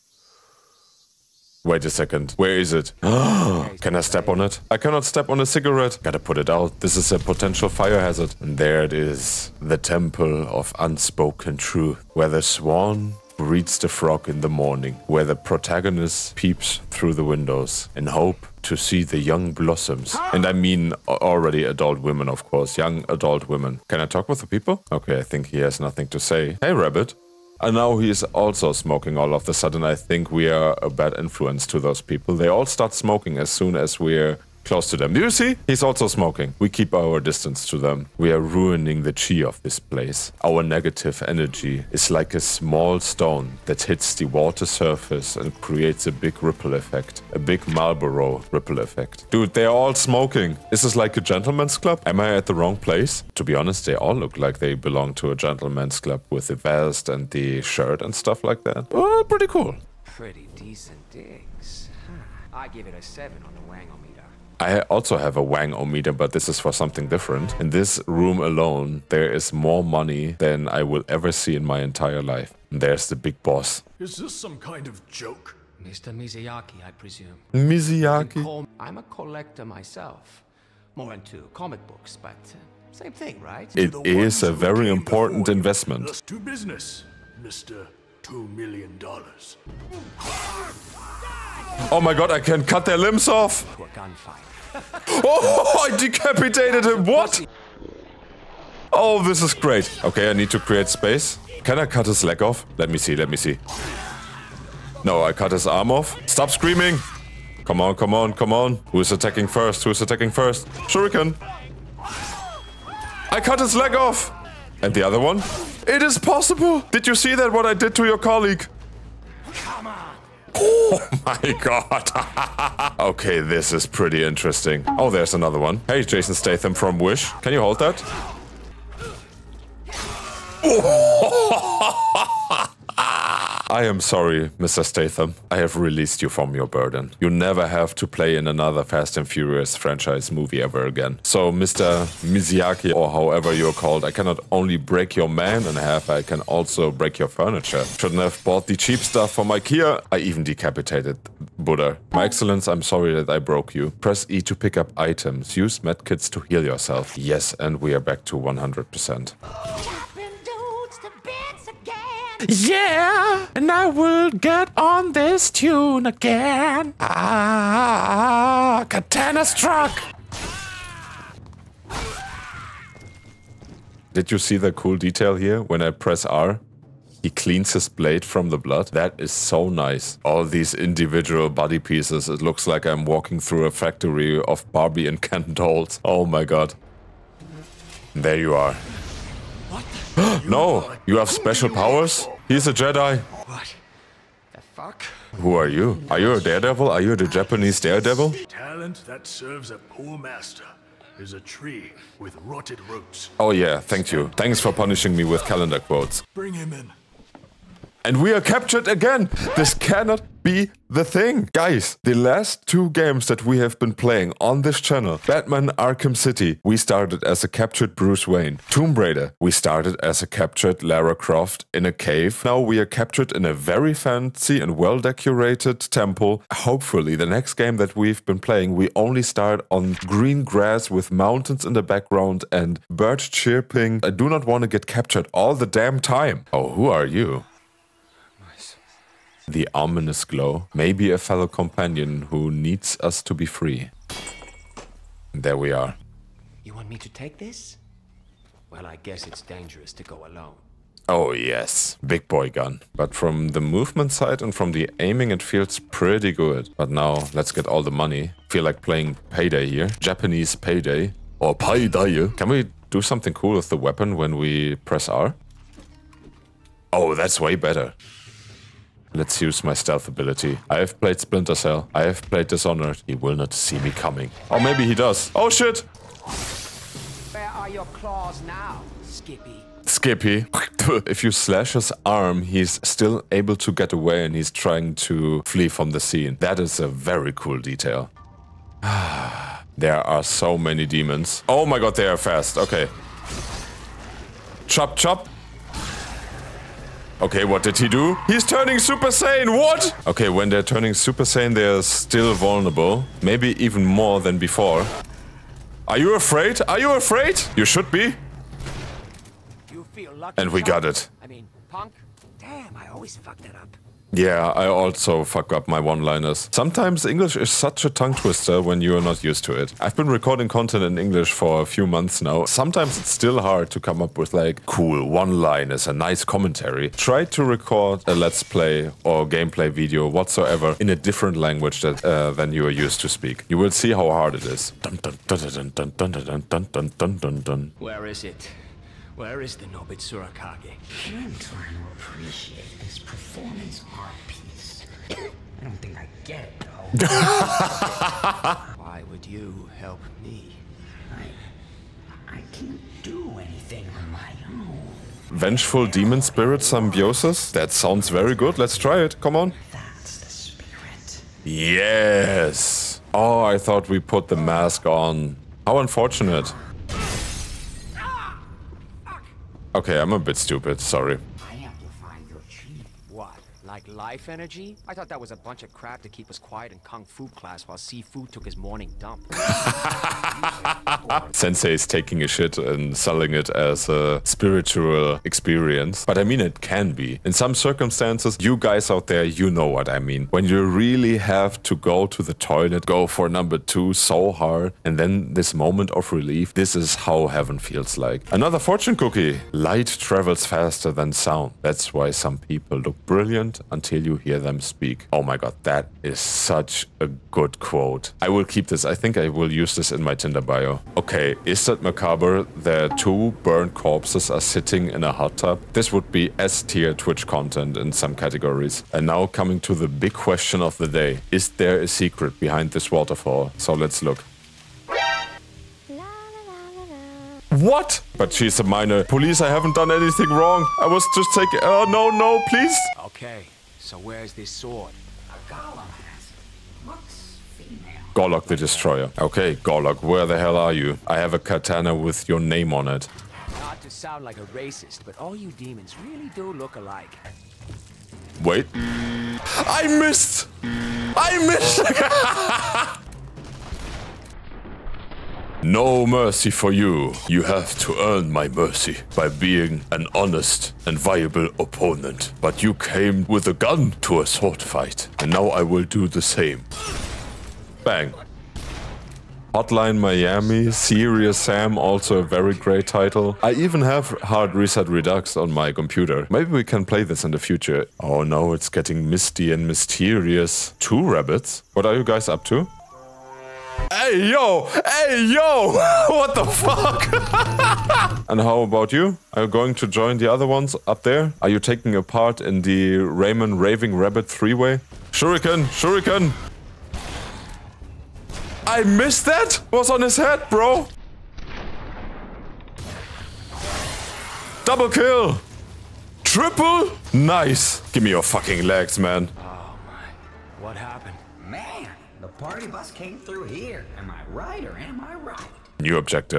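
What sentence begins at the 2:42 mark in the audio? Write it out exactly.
Yeah, and I will get on this tune again.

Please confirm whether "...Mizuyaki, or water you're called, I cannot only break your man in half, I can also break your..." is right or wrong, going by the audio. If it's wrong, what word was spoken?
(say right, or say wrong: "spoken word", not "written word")
wrong: "however", not "water".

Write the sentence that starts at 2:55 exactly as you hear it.
When I press R, he cleans his blade from the blood.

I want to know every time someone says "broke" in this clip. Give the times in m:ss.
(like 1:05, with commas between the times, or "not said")
2:33.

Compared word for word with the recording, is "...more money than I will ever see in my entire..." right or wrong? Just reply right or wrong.
right.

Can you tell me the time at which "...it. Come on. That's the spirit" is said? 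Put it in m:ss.
5:58.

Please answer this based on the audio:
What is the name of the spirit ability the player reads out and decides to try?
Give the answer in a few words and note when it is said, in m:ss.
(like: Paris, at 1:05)
Vengeful Demon Spirit Symbiosis, at 5:55.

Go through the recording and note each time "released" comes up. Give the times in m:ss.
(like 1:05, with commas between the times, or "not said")
2:15.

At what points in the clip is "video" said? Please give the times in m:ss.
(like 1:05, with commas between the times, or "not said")
5:29.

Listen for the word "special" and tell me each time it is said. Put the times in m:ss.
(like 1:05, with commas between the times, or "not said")
3:11.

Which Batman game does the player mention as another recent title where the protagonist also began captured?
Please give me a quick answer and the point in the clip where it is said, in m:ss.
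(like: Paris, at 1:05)
Batman Arkham City, at 3:35.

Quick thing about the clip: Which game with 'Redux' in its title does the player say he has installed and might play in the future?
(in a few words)
Hard Reset Redux.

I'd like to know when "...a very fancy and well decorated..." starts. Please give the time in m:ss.
3:43.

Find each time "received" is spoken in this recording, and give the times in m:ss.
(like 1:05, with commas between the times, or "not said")
not said.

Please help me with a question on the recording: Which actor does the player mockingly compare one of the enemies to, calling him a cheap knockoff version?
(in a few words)
Jason Statham.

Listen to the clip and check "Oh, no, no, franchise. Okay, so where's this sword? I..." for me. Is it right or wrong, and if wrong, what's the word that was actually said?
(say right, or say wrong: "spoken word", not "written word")
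wrong: "please", not "franchise".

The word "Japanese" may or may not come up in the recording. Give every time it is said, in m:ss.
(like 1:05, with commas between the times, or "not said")
3:17, 4:19.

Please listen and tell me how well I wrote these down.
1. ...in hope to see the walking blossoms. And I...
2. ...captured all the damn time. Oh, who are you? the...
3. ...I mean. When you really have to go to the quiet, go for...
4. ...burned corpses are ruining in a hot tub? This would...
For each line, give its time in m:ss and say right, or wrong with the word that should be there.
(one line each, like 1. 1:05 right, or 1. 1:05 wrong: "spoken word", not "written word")
1. 0:17 wrong: "young", not "walking"
2. 3:54 right
3. 6:29 wrong: "toilet", not "quiet"
4. 6:53 wrong: "sitting", not "ruining".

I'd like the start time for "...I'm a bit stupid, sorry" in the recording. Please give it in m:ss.
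6:09.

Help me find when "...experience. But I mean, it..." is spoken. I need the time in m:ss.
6:25.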